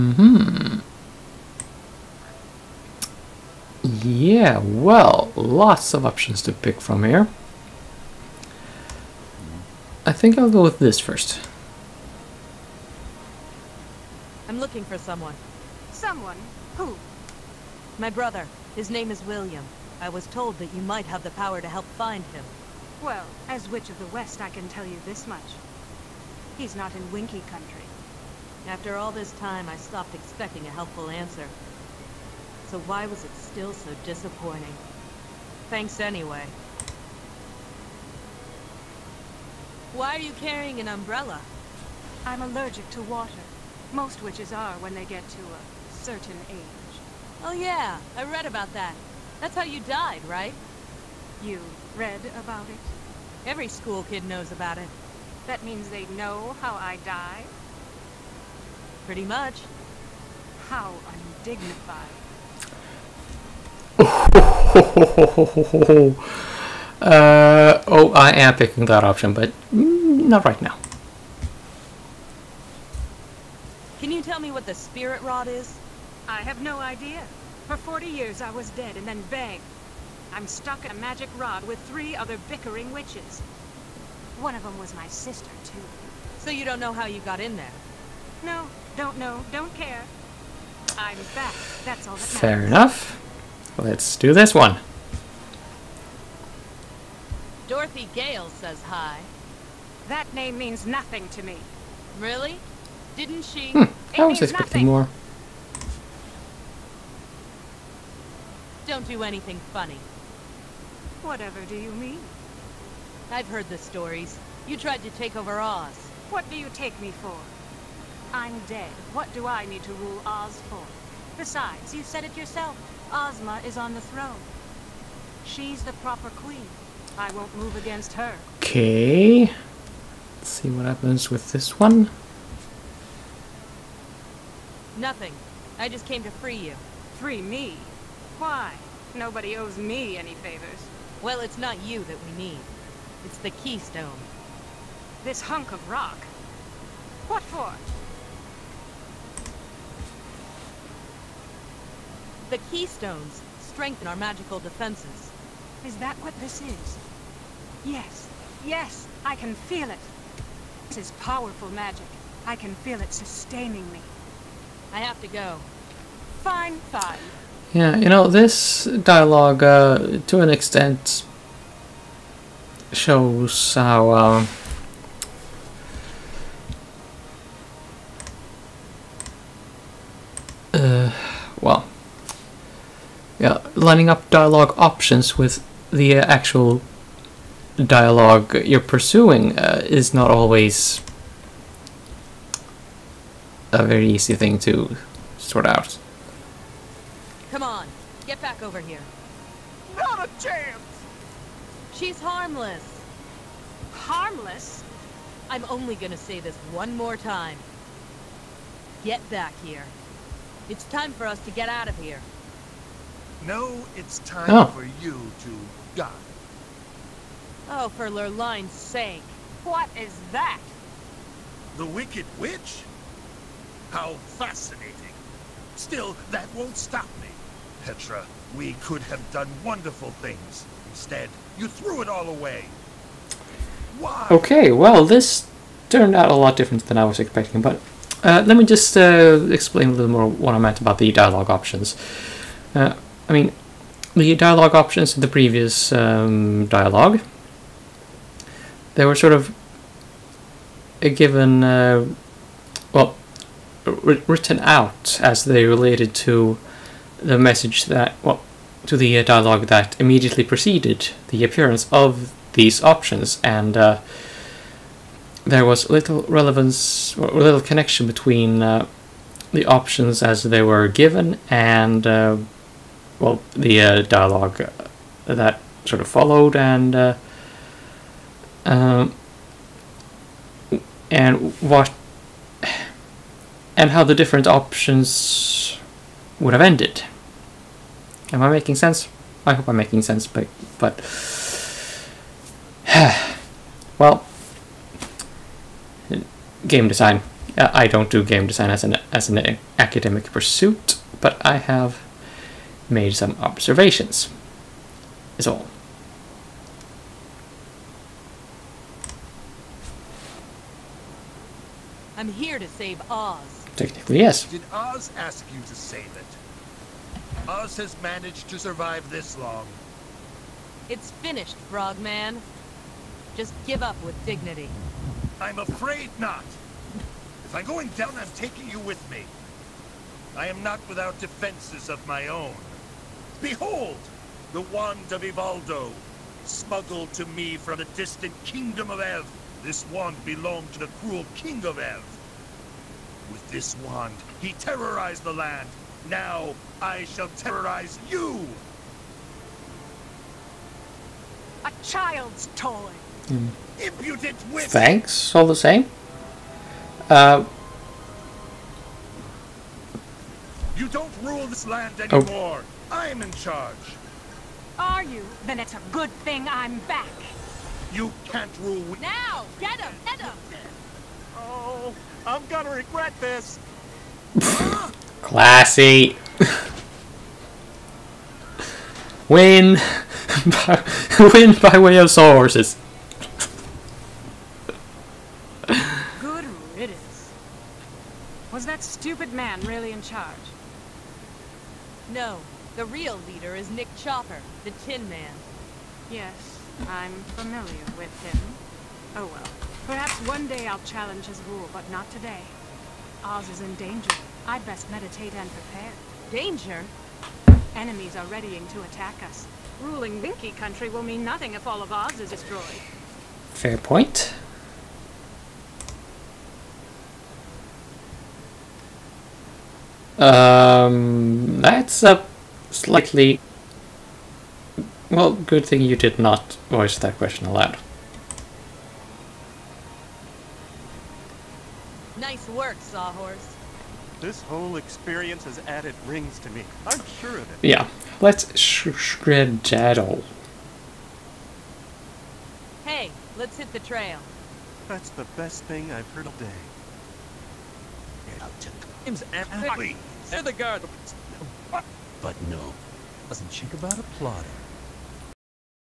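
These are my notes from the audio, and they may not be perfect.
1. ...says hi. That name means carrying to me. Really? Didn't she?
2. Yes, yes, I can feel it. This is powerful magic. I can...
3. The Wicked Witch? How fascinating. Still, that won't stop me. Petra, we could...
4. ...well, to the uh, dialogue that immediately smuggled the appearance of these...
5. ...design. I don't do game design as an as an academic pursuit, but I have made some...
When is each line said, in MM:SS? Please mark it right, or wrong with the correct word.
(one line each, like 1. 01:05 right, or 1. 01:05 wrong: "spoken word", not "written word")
1. 01:38 wrong: "nothing", not "carrying"
2. 02:37 right
3. 03:41 right
4. 04:18 wrong: "preceded", not "smuggled"
5. 04:56 right.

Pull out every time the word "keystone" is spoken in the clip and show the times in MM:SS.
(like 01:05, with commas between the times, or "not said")
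02:23, 02:32.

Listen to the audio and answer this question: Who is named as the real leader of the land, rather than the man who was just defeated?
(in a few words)
Nick Chopper.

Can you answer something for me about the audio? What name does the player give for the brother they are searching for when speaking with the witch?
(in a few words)
William.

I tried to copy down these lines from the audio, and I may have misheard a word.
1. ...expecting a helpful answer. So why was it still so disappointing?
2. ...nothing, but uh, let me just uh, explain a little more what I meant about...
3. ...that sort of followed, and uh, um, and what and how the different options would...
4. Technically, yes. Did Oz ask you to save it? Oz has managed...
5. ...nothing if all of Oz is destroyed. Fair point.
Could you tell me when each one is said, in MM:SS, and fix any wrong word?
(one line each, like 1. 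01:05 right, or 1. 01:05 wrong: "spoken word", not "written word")
1. 00:30 right
2. 03:57 wrong: "expecting", not "nothing"
3. 04:35 right
4. 05:13 right
5. 06:51 right.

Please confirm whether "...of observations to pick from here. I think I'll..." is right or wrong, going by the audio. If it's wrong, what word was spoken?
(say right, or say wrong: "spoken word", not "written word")
wrong: "options", not "observations".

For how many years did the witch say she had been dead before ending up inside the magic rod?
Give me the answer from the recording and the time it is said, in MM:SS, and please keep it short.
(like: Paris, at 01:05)
40, at 01:17.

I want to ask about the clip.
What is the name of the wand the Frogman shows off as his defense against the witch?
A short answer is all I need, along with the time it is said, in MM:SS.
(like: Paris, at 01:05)
wand of Evoldo, at 05:34.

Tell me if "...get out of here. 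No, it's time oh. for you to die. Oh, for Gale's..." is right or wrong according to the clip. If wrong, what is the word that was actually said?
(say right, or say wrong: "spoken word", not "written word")
wrong: "Lurline", not "Gale".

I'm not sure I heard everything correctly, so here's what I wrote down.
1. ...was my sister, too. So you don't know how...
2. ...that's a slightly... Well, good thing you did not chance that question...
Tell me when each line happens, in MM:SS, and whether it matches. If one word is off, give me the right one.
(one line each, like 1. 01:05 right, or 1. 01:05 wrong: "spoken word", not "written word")
1. 01:24 right
2. 07:01 wrong: "voice", not "chance".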